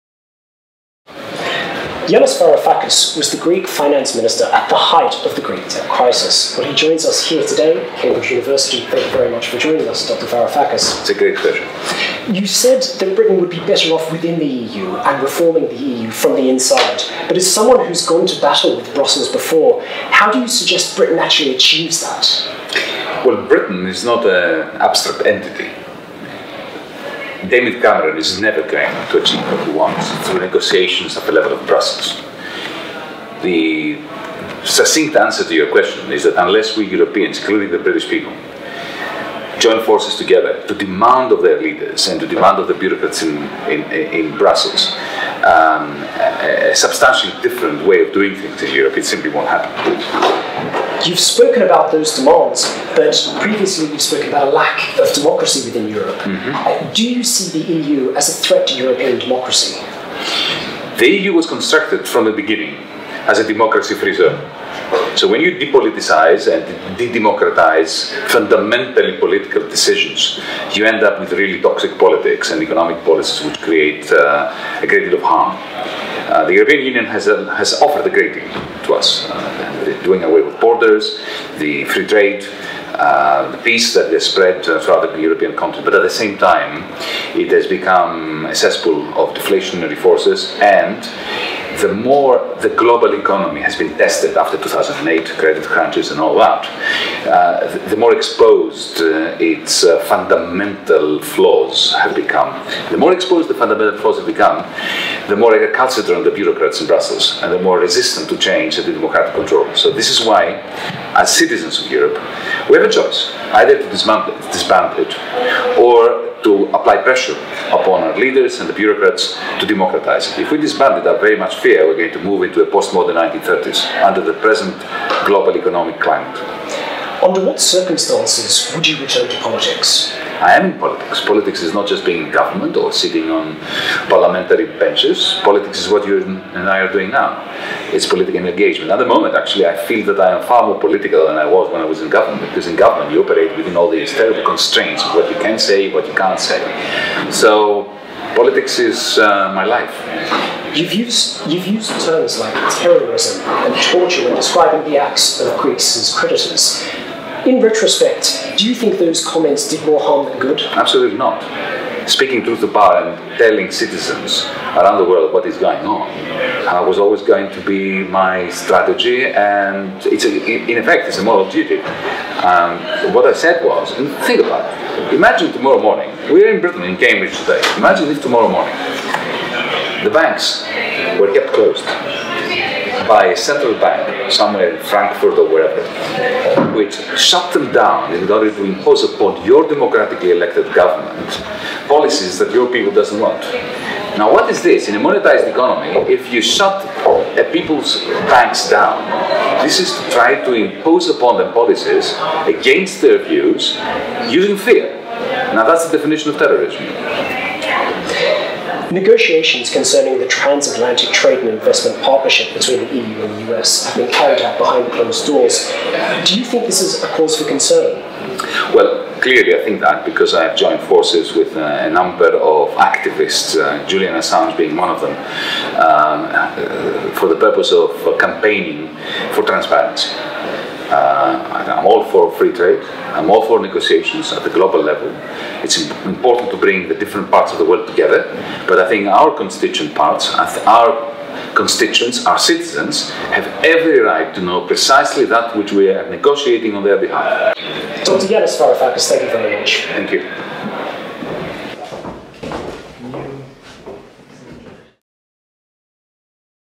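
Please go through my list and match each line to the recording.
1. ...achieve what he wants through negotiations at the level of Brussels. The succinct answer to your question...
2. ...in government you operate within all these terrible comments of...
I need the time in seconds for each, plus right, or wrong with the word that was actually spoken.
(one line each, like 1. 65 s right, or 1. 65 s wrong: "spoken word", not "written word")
1. 29 s right
2. 142 s wrong: "constraints", not "comments".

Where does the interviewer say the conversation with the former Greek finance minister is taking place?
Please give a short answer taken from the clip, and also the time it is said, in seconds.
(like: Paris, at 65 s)
Cambridge University, at 7 s.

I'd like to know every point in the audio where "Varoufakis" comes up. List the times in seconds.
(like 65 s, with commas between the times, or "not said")
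2 s, 10 s, 248 s.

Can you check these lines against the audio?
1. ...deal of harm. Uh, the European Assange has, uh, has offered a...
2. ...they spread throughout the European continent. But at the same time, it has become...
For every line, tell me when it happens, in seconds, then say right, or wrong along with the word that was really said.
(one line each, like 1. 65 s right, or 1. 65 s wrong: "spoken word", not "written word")
1. 75 s wrong: "Union", not "Assange"
2. 84 s right.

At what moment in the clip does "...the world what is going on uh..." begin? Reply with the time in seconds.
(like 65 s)
164 s.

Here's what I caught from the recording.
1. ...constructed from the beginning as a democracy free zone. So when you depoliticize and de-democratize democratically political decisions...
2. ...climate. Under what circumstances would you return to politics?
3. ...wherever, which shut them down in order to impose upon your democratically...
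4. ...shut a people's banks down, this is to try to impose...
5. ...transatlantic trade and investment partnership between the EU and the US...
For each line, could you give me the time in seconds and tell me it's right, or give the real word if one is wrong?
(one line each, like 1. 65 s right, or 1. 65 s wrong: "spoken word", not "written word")
1. 61 s wrong: "fundamentally", not "democratically"
2. 125 s right
3. 185 s right
4. 196 s right
5. 210 s right.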